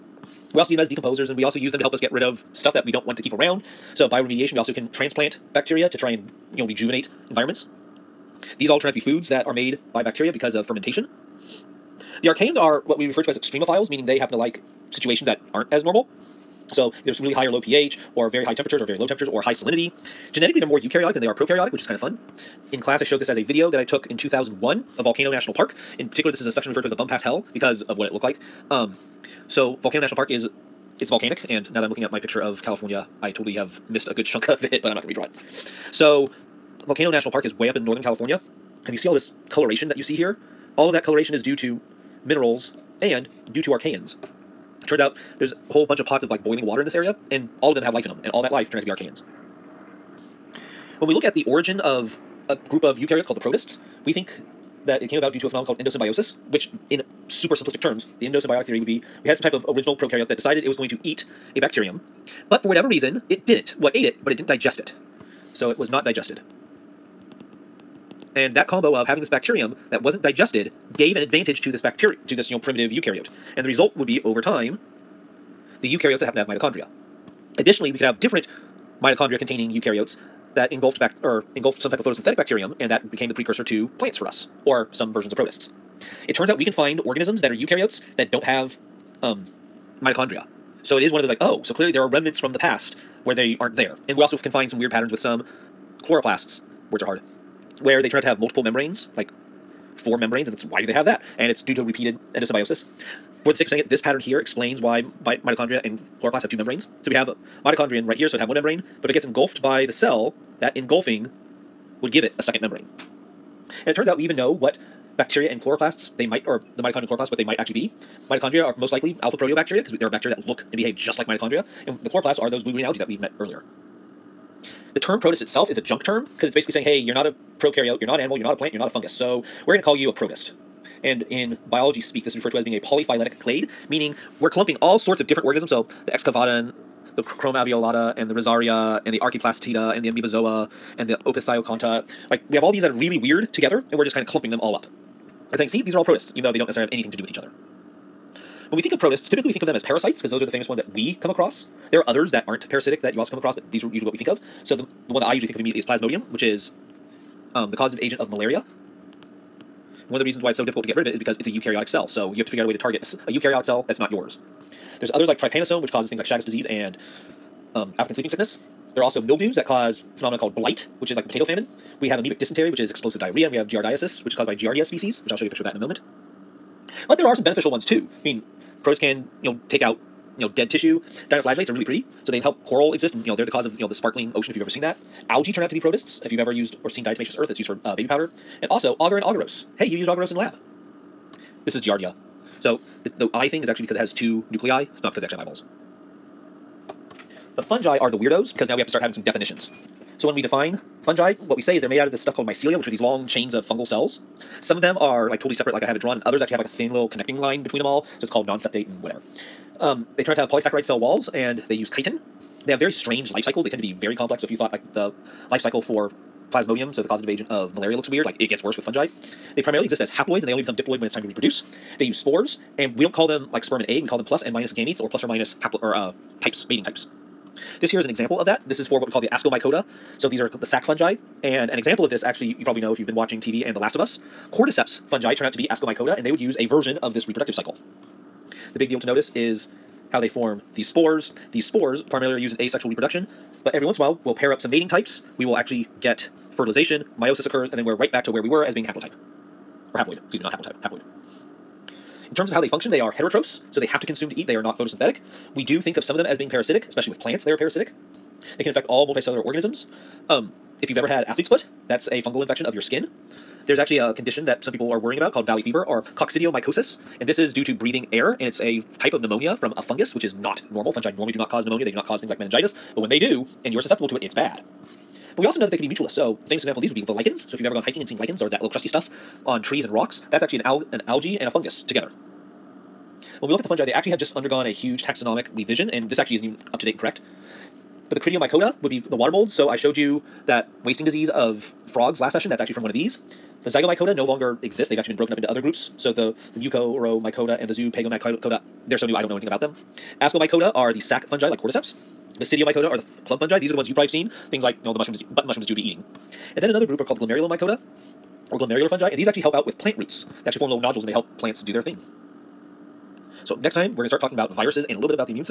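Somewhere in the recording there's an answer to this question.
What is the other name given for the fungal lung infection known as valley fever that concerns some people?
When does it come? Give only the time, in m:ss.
4:26.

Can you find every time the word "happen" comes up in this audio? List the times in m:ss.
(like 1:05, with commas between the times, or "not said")
0:14, 1:16.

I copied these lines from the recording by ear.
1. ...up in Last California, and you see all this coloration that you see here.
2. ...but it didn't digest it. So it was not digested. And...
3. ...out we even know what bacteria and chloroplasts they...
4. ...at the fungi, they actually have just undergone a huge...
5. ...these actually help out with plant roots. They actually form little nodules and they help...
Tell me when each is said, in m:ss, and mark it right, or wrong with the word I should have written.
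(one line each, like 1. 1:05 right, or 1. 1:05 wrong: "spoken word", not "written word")
1. 0:37 wrong: "Northern", not "Last"
2. 1:04 right
3. 1:54 right
4. 4:43 right
5. 5:09 right.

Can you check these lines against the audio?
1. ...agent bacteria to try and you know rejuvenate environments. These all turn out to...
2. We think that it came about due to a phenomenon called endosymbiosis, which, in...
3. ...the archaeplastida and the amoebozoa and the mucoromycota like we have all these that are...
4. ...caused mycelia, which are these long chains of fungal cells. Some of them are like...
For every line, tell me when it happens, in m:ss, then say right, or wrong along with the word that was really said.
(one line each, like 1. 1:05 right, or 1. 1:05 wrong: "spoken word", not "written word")
1. 0:04 wrong: "transplant", not "agent"
2. 0:54 right
3. 2:19 wrong: "opisthokonta", not "mucoromycota"
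4. 3:22 wrong: "called", not "caused".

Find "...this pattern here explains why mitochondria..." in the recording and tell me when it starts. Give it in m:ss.
1:43.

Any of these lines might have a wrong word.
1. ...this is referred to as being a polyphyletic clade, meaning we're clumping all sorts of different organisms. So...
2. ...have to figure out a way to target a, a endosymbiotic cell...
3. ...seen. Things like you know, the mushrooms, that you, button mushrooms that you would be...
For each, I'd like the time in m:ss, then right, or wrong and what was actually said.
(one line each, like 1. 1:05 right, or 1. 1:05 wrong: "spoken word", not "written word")
1. 2:12 right
2. 2:42 wrong: "eukaryotic", not "endosymbiotic"
3. 5:04 right.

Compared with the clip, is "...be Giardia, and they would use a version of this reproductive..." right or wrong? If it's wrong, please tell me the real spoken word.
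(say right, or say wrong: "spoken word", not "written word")
wrong: "Ascomycota", not "Giardia".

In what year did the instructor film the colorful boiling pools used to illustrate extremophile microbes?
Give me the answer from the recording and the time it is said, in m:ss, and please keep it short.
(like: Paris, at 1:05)
2001, at 0:24.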